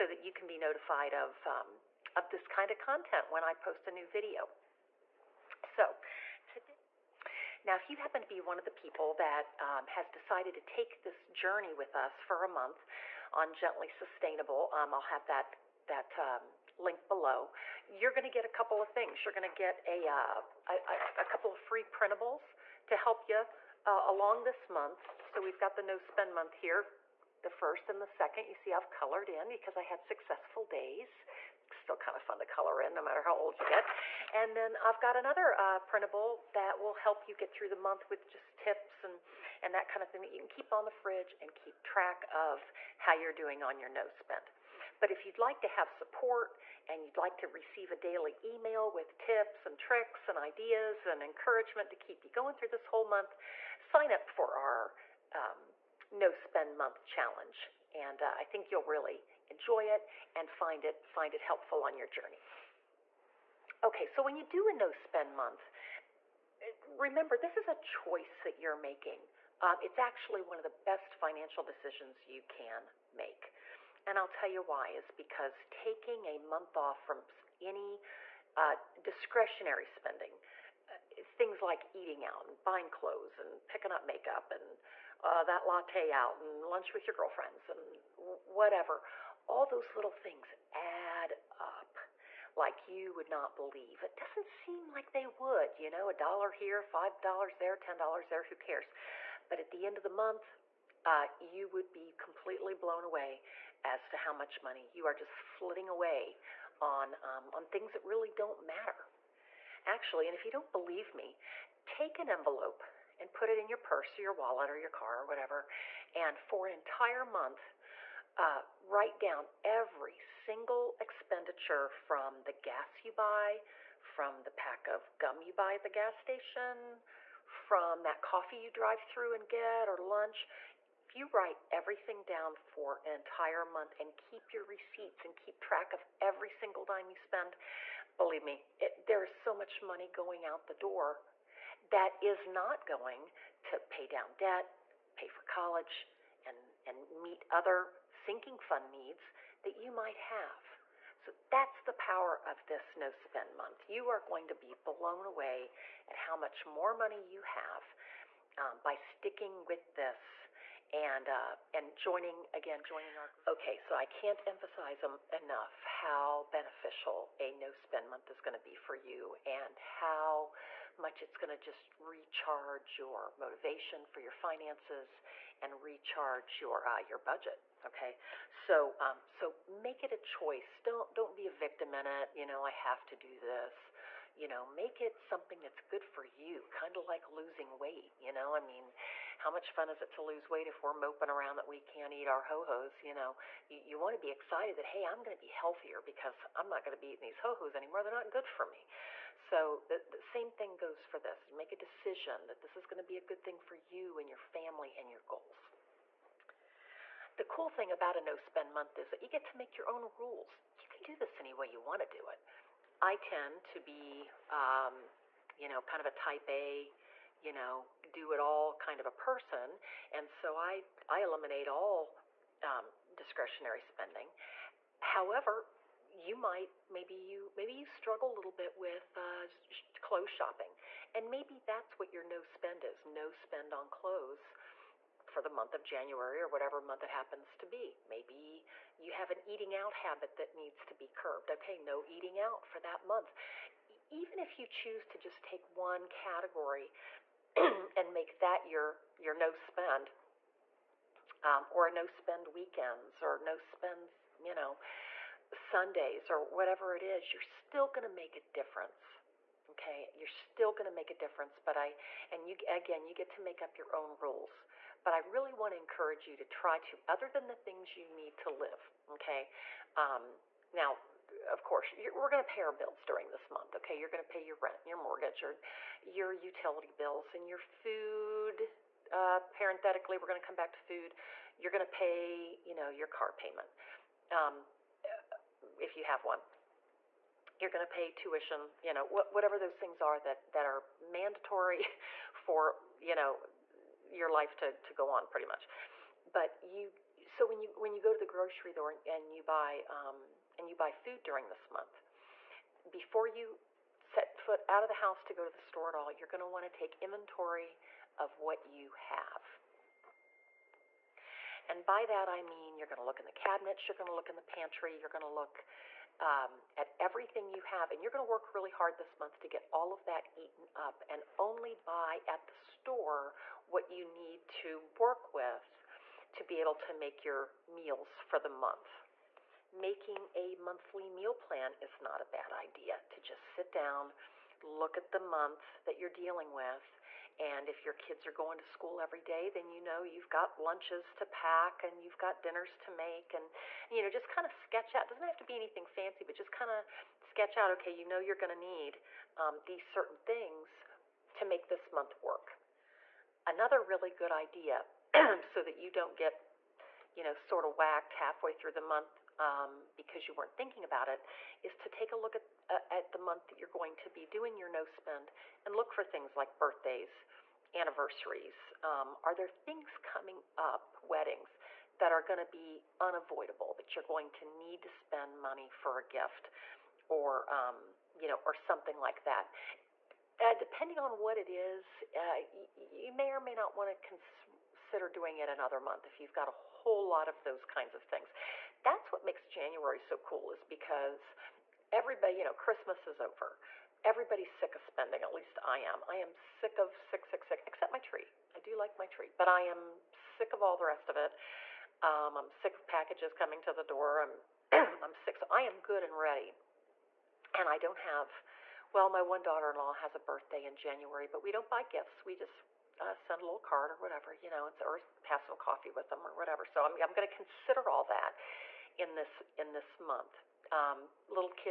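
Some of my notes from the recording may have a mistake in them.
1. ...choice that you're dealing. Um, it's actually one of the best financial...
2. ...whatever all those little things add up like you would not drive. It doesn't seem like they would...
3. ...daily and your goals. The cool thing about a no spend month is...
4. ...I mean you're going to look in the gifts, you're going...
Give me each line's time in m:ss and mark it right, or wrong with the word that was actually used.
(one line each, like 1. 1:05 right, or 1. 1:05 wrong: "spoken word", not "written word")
1. 1:07 wrong: "making", not "dealing"
2. 1:28 wrong: "believe", not "drive"
3. 3:24 wrong: "family", not "daily"
4. 5:12 wrong: "cabinets", not "gifts".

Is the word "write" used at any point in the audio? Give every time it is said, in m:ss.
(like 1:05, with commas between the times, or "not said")
1:58, 2:11.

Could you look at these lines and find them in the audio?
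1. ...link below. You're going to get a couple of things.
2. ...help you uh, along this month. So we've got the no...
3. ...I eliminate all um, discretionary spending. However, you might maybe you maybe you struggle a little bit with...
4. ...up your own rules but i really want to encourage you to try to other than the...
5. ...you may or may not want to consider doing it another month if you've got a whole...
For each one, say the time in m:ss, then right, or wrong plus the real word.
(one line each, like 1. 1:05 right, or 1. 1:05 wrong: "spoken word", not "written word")
1. 0:16 right
2. 0:22 right
3. 3:41 right
4. 4:23 right
5. 6:22 right.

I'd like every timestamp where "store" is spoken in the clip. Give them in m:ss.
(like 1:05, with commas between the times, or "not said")
4:58, 5:05, 5:22.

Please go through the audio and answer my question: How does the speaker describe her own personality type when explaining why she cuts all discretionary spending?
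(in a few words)
Type A.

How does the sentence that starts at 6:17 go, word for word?
Or um, you know, or something like that.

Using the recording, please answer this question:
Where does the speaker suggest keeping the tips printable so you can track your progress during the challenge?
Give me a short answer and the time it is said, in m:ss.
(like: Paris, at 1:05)
On the fridge, at 0:40.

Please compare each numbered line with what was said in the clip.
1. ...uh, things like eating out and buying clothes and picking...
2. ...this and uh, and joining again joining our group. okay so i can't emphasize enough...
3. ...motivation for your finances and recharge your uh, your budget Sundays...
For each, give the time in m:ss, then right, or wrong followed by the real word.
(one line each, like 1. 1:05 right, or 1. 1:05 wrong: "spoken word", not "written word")
1. 1:20 right
2. 2:39 right
3. 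2:53 wrong: "Okay", not "Sundays".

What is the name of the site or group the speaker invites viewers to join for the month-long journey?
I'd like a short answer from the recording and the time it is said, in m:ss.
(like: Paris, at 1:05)
Gently Sustainable, at 0:13.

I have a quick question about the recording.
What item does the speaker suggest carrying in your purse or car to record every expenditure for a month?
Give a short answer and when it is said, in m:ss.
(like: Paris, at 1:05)
An envelope, at 1:52.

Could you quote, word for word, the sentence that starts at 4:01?
Okay, no eating out for that month.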